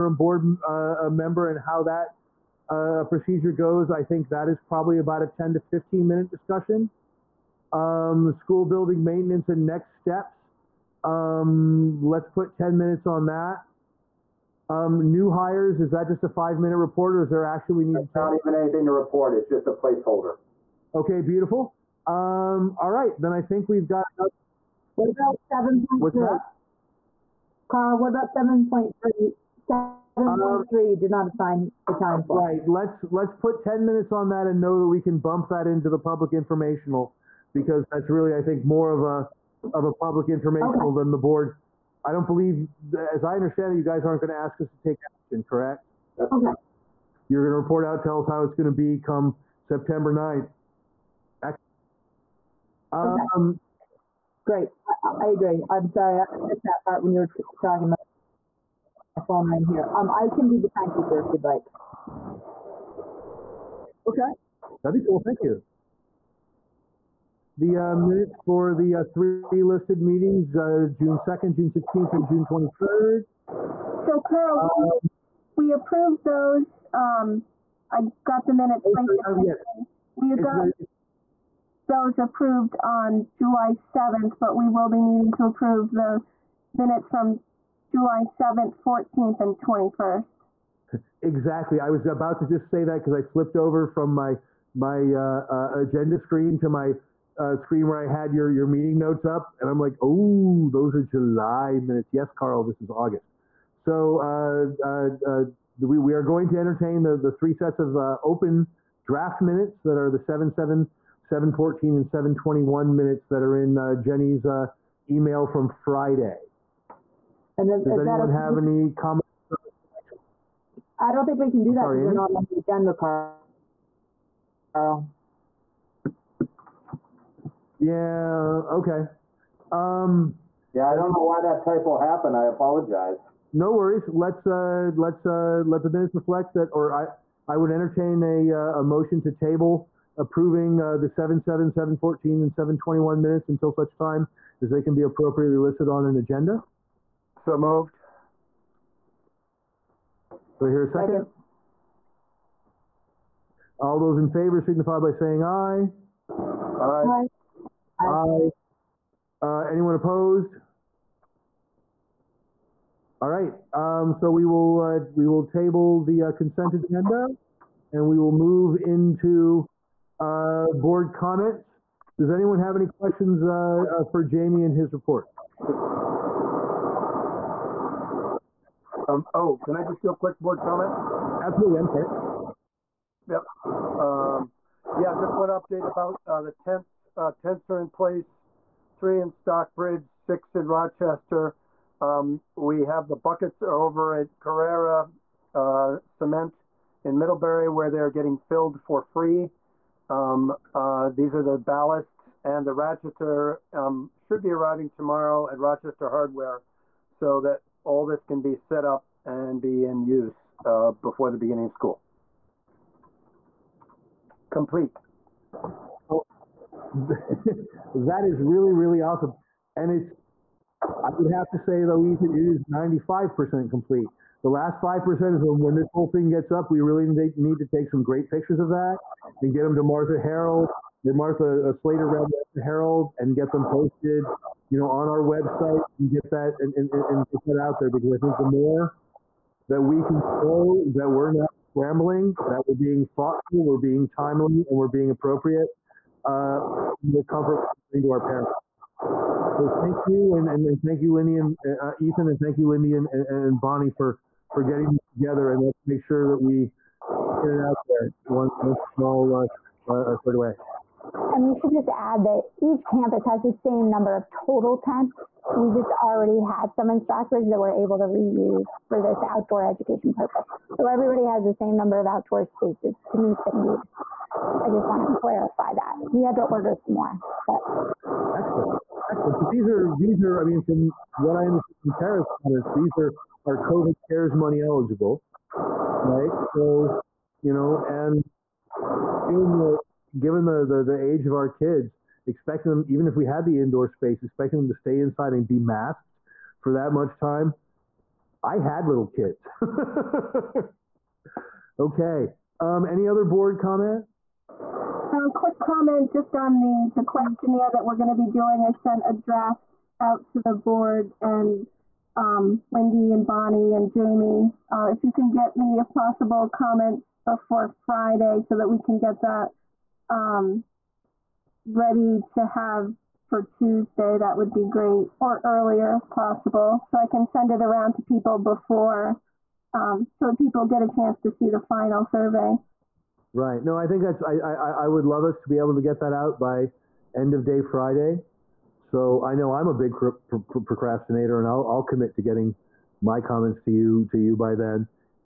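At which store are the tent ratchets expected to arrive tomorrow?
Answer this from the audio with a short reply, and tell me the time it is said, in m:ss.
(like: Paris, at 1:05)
Rochester Hardware, at 3:25.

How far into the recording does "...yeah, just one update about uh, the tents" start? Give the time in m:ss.
3:04.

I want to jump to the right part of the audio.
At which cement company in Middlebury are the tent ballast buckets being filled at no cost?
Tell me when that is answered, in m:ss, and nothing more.
3:14.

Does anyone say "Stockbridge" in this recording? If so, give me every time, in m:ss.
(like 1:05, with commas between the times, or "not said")
3:09, 4:26.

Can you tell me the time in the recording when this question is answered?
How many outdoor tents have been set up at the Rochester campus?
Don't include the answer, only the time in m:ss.
3:10.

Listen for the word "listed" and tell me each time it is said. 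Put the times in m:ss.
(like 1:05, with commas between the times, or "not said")
1:09, 2:25.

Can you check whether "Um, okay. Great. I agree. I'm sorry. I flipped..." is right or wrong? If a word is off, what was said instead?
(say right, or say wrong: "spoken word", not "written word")
wrong: "missed", not "flipped".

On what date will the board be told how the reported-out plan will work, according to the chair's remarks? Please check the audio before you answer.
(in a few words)
September 9th.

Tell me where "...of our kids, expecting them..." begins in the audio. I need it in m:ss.
4:51.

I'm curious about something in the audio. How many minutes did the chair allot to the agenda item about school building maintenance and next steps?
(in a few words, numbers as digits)
10.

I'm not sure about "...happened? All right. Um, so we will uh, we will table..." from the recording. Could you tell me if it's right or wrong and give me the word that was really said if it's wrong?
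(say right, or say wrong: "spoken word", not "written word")
wrong: "opposed", not "happened".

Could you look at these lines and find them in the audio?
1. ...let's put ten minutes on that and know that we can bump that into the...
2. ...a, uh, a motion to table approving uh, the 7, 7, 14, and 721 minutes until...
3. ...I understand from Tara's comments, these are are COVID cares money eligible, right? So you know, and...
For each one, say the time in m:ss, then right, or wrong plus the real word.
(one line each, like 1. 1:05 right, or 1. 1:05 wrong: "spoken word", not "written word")
1. 0:33 right
2. 2:18 right
3. 4:41 right.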